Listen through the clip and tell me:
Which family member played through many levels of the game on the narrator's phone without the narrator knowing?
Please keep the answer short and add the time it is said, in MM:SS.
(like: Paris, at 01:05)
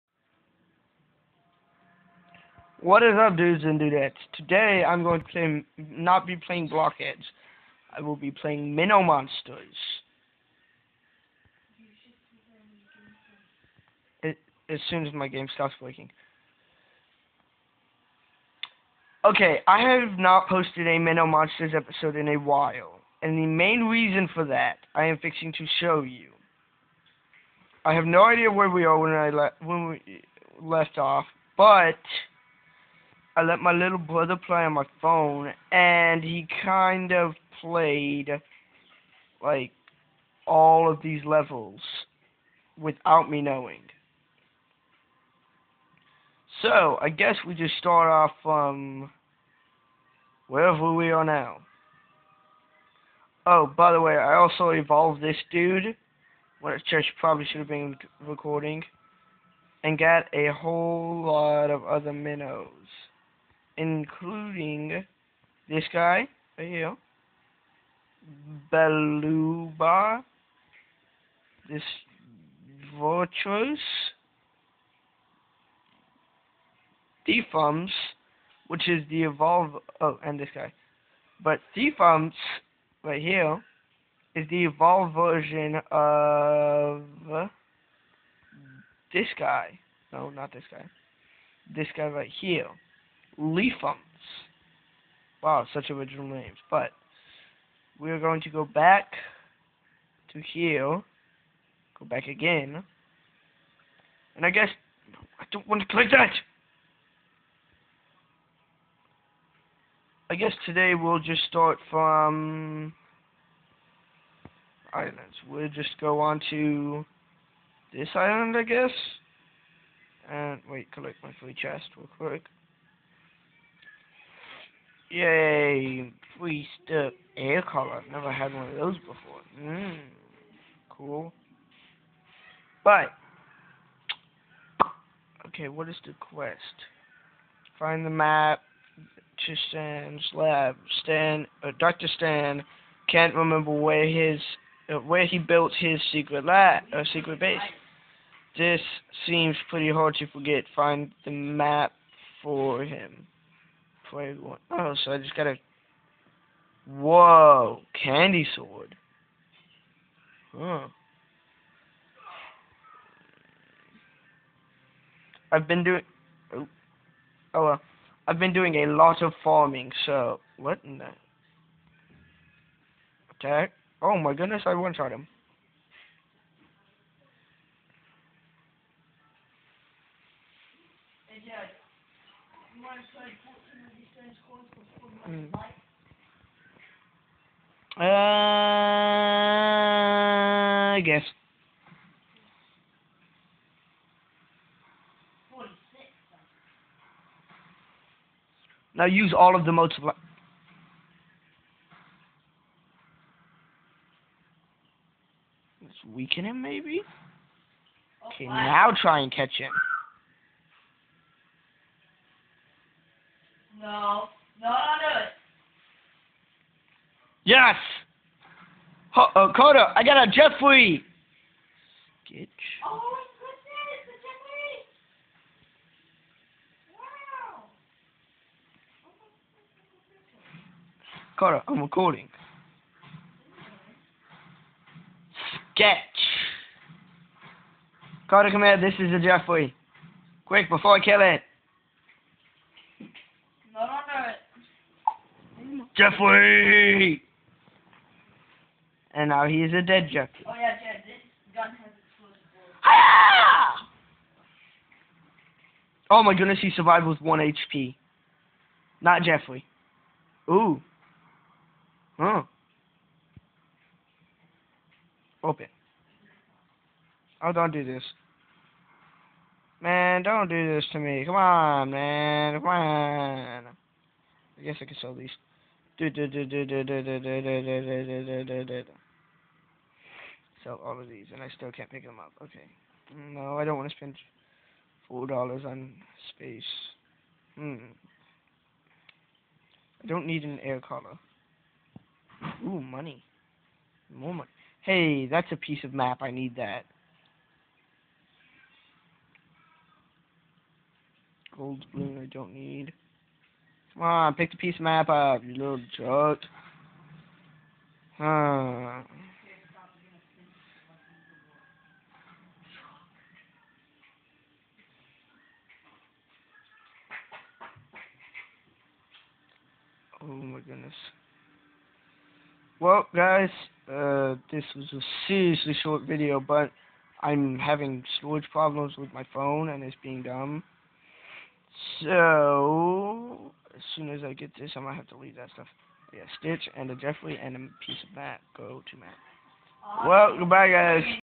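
little brother, at 00:33.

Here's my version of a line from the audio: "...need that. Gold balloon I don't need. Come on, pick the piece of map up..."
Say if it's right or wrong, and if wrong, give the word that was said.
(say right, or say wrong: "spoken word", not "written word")
right.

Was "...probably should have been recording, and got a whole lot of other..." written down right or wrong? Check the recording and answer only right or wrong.
right.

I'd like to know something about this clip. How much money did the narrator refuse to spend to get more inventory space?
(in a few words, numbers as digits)
$4.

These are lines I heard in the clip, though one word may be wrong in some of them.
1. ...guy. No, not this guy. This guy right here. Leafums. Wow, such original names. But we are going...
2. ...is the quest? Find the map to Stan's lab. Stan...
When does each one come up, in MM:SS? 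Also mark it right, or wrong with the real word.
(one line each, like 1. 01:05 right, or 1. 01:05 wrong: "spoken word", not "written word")
1. 01:29 right
2. 02:15 right.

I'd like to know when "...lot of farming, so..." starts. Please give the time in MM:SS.
02:48.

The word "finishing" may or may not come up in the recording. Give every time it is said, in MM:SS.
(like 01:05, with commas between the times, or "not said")
not said.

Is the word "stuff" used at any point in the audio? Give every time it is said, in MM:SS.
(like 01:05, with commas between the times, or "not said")
02:06, 05:35.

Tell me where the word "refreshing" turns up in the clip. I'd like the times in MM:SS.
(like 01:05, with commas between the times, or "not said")
not said.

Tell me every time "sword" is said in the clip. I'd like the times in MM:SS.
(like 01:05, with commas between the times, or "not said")
02:38.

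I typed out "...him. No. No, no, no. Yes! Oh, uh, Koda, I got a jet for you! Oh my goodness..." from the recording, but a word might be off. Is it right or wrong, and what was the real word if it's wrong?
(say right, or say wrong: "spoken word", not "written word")
right.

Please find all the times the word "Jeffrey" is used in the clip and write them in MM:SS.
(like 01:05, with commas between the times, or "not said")
04:06, 04:19, 05:36.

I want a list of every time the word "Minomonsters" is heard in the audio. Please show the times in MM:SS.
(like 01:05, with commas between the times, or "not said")
00:08, 00:20.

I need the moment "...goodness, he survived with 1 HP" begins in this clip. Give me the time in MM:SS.
04:16.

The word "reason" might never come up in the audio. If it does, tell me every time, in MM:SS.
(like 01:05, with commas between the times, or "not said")
00:23.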